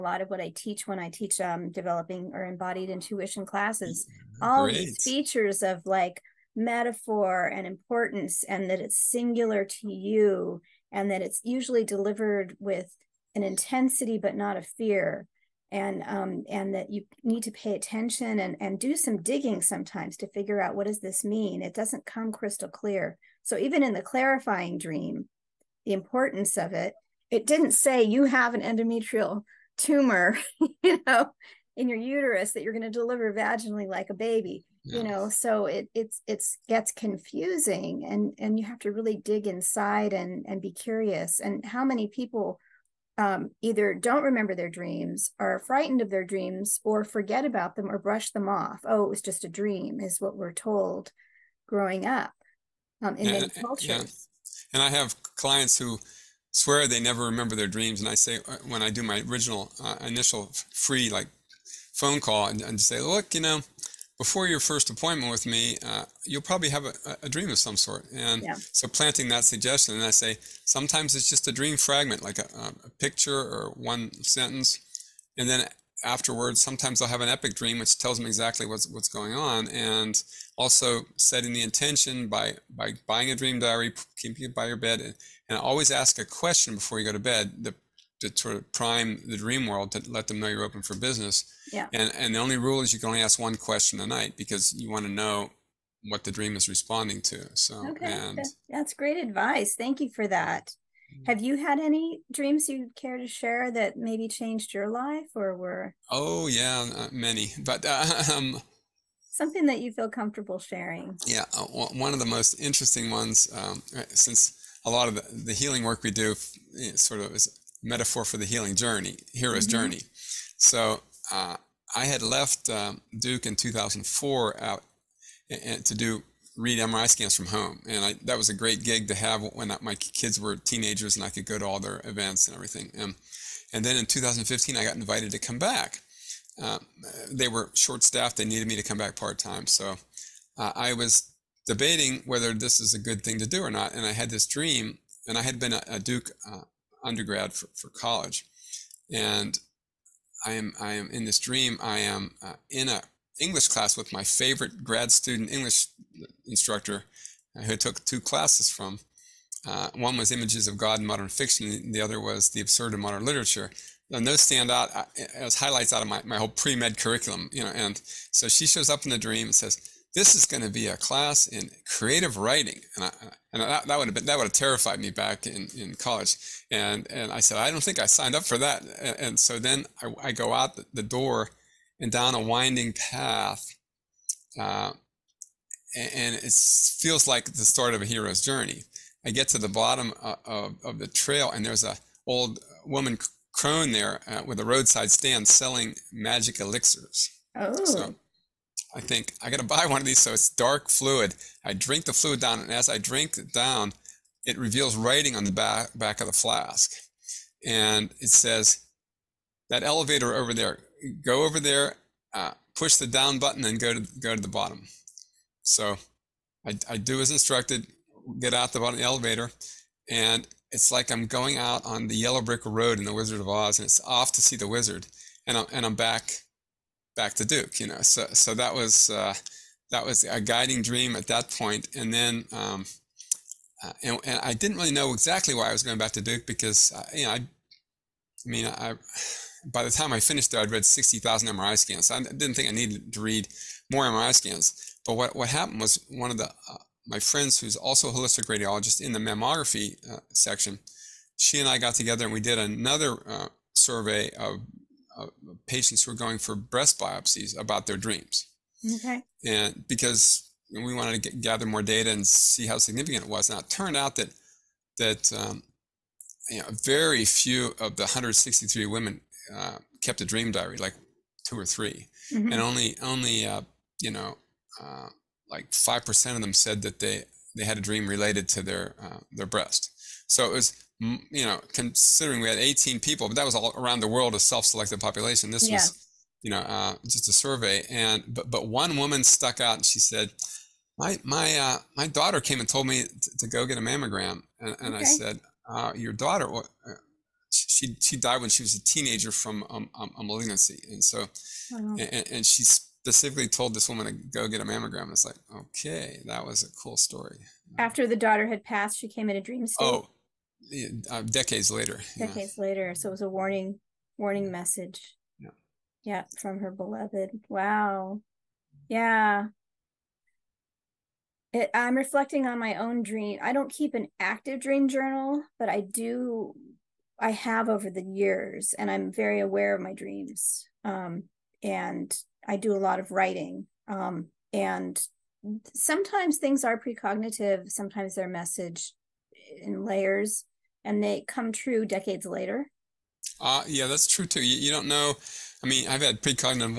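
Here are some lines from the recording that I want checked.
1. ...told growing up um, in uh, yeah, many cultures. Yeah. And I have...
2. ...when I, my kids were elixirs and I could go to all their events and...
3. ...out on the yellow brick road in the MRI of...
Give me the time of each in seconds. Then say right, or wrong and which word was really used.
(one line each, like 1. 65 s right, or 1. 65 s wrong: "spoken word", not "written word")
1. 50 s right
2. 129 s wrong: "teenagers", not "elixirs"
3. 221 s wrong: "Wizard", not "MRI".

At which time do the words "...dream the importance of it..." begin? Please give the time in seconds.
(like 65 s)
24 s.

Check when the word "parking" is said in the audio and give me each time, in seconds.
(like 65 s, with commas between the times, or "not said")
not said.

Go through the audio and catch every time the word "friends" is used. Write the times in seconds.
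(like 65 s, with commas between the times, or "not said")
247 s.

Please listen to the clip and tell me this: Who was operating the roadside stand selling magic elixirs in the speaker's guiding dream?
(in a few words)
old woman crone.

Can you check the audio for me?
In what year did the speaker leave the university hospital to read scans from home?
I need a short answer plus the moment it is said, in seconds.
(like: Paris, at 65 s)
2004, at 123 s.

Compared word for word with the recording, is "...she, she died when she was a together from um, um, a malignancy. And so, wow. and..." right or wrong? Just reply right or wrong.
wrong.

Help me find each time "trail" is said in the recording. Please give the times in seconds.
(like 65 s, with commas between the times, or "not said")
191 s.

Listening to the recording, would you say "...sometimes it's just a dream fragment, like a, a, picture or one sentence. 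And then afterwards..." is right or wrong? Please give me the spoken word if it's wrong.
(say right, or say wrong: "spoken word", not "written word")
right.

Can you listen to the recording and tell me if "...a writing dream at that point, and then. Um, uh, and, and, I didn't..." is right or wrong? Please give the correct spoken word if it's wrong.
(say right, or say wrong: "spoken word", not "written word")
wrong: "guiding", not "writing".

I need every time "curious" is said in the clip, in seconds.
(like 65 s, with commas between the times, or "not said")
40 s.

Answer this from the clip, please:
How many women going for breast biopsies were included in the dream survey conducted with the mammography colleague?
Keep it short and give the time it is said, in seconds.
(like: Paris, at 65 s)
163, at 268 s.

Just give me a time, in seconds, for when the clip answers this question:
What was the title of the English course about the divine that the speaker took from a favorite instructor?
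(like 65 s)
160 s.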